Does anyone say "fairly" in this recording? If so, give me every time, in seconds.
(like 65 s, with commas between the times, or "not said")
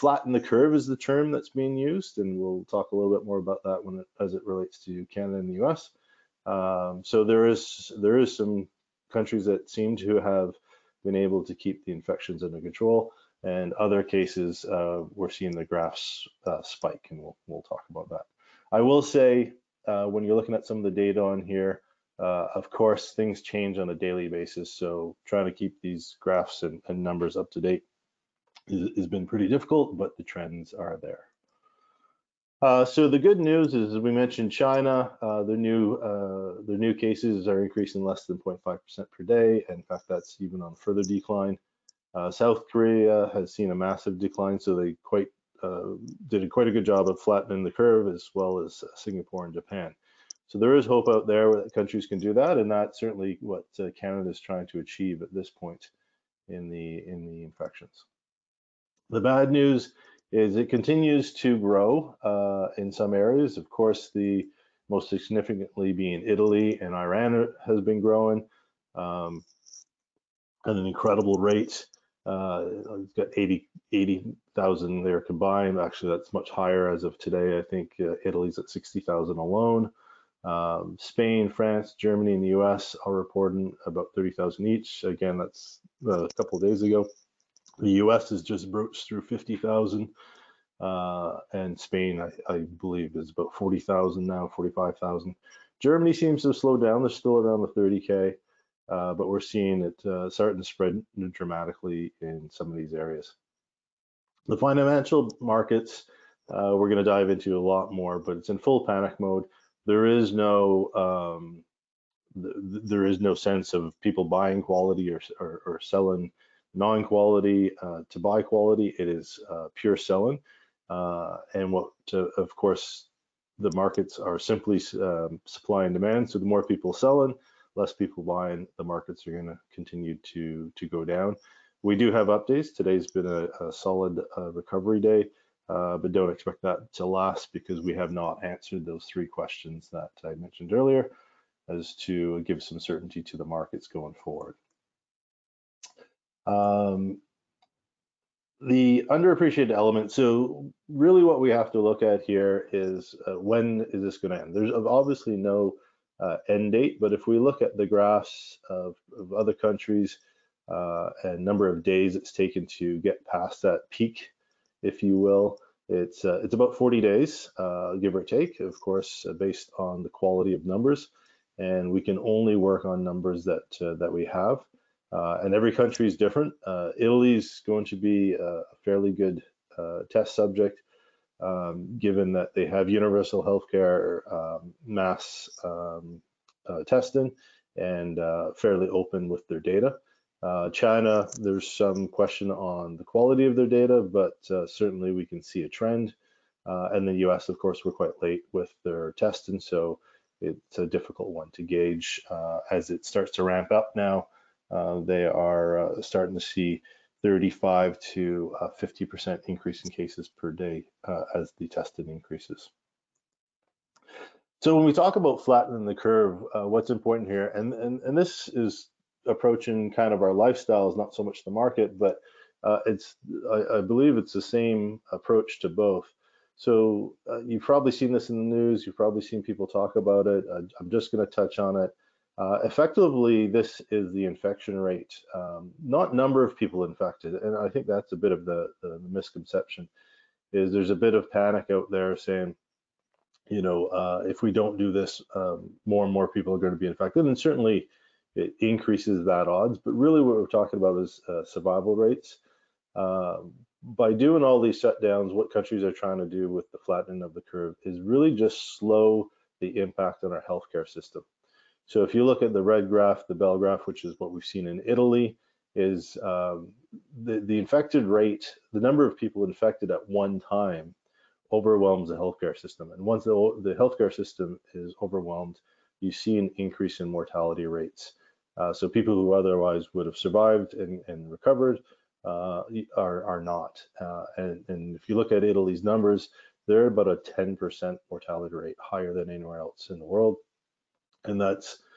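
178 s, 188 s.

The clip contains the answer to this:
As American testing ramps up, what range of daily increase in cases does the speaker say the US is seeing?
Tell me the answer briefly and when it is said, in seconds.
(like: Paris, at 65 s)
35 to 50%, at 207 s.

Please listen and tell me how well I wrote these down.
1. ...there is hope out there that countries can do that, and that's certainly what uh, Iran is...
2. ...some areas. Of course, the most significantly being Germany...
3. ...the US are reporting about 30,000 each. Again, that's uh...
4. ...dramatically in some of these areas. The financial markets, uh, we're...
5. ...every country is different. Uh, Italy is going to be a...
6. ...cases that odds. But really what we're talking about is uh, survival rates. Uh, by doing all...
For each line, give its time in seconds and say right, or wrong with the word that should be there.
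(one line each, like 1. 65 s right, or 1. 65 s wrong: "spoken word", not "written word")
1. 50 s wrong: "Canada", not "Iran"
2. 62 s wrong: "Italy", not "Germany"
3. 82 s right
4. 101 s right
5. 175 s right
6. 248 s wrong: "increases", not "cases".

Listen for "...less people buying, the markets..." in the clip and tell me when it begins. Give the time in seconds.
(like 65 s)
127 s.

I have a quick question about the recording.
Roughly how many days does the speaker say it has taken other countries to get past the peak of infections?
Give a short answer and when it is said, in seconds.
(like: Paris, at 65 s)
40 days, at 166 s.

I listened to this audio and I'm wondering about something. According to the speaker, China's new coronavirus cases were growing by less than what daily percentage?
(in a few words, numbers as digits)
0.5%.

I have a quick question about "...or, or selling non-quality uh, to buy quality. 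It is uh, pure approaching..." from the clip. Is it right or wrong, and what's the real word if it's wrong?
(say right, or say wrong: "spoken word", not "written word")
wrong: "selling", not "approaching".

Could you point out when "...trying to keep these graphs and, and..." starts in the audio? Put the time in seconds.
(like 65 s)
25 s.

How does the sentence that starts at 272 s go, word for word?
And once the, the healthcare system is overwhelmed, you see an increase in mortality rates.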